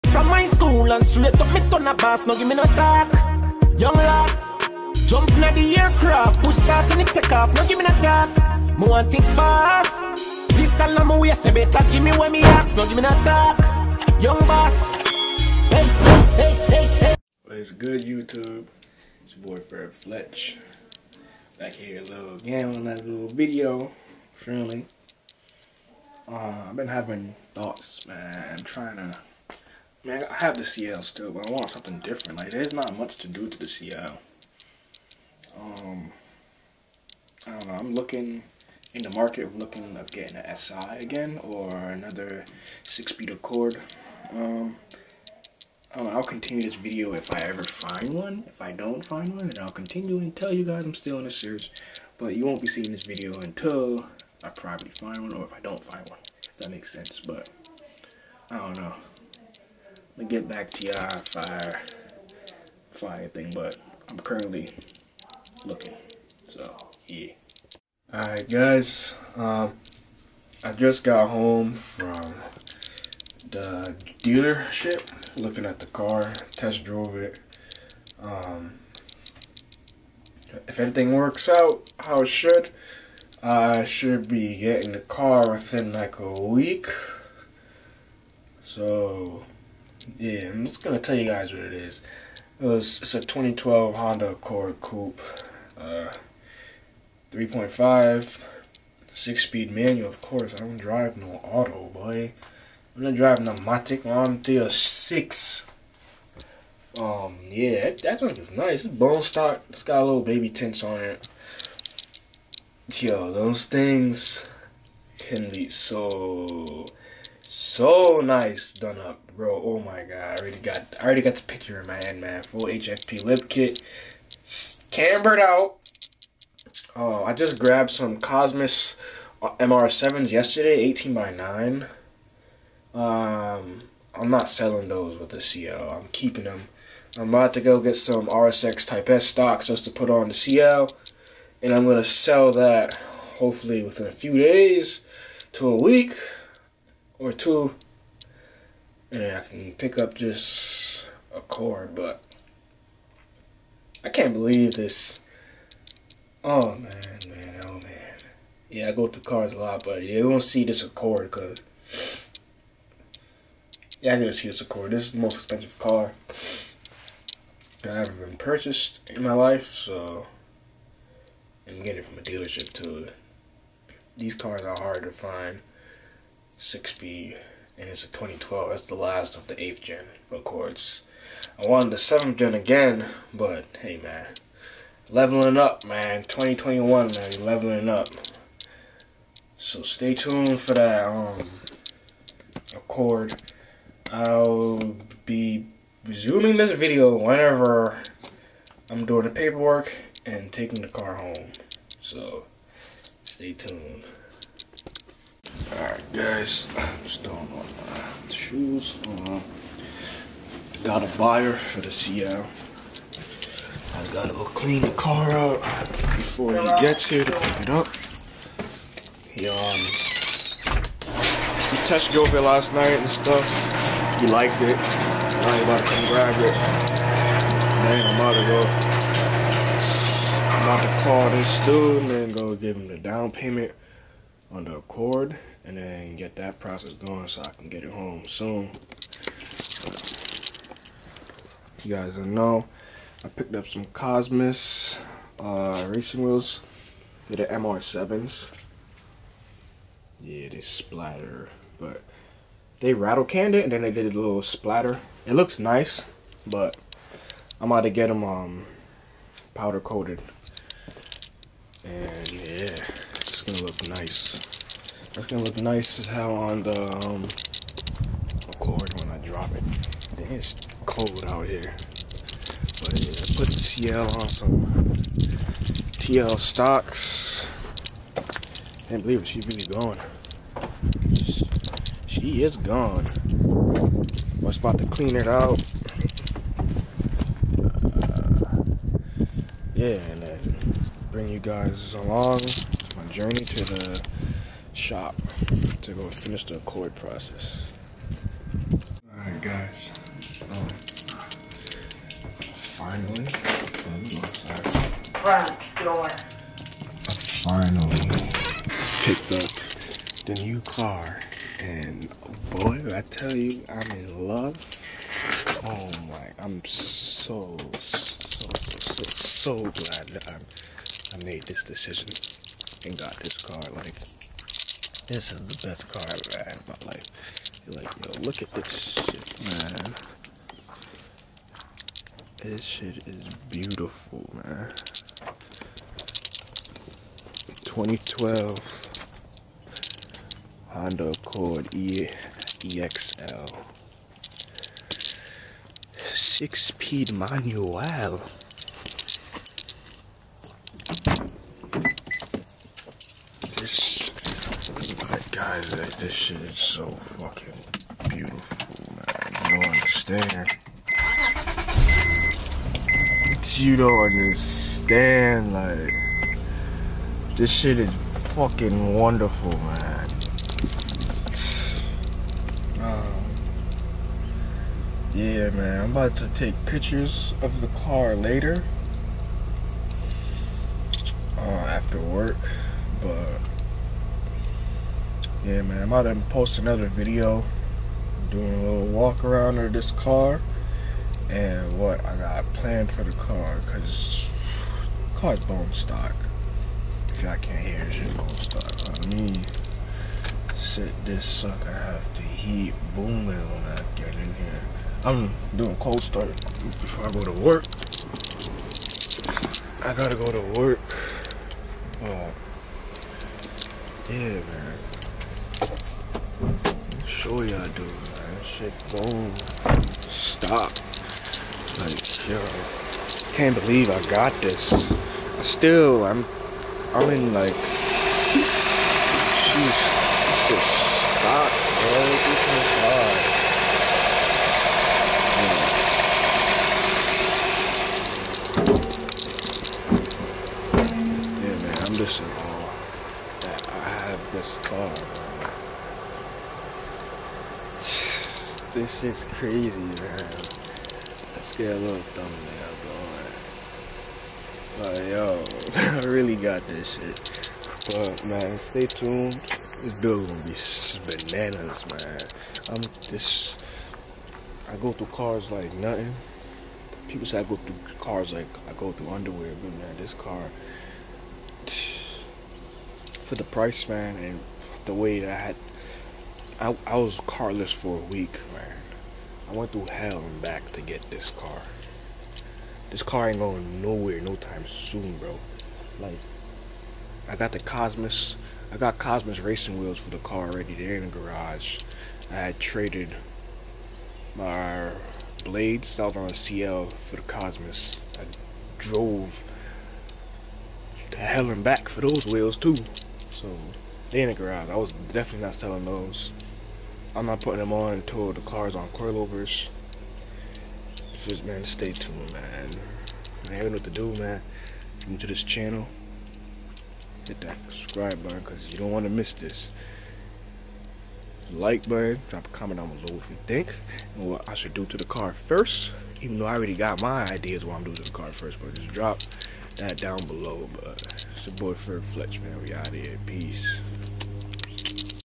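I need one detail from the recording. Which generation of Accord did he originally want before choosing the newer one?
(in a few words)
7th gen.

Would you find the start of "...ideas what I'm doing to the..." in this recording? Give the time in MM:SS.
08:47.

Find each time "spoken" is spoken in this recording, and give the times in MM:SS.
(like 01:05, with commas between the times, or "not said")
not said.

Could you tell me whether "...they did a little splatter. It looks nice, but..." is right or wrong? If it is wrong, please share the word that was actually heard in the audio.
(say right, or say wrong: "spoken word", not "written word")
right.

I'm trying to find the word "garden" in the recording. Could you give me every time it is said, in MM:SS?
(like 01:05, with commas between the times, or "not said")
not said.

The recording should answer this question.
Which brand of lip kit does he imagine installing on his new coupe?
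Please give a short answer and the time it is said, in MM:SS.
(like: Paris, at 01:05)
HFP, at 02:02.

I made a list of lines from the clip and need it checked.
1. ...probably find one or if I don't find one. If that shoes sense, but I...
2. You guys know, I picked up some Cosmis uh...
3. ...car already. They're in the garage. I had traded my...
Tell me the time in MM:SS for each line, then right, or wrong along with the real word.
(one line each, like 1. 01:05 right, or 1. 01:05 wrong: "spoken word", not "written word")
1. 00:54 wrong: "makes", not "shoes"
2. 04:01 right
3. 08:10 right.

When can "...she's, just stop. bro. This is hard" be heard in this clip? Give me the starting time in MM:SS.
07:07.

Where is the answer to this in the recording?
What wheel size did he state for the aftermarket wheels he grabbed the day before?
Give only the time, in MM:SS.
02:10.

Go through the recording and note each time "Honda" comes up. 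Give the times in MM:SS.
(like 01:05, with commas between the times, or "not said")
01:33, 05:40.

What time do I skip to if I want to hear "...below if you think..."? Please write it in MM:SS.
08:42.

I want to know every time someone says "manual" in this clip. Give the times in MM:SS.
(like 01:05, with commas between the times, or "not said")
01:39, 05:47.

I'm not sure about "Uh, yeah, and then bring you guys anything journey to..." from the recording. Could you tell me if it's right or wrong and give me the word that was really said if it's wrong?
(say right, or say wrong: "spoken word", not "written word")
wrong: "along", not "anything".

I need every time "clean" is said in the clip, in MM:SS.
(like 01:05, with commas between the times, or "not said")
03:34, 04:44.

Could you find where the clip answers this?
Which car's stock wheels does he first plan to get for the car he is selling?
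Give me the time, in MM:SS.
02:18.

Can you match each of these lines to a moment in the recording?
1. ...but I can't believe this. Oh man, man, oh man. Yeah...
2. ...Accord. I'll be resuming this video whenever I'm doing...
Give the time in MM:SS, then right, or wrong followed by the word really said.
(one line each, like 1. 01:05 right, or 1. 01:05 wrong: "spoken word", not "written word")
1. 02:31 right
2. 03:12 right.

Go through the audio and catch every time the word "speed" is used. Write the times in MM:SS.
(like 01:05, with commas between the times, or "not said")
00:42, 01:39, 05:46.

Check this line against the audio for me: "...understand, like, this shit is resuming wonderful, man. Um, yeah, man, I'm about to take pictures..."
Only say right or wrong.
wrong.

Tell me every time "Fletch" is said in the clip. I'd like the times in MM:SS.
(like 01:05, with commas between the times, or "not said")
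00:19, 08:52.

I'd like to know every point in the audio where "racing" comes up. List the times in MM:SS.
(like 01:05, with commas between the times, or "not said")
04:05, 08:09.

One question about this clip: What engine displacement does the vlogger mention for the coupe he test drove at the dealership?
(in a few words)
3.5.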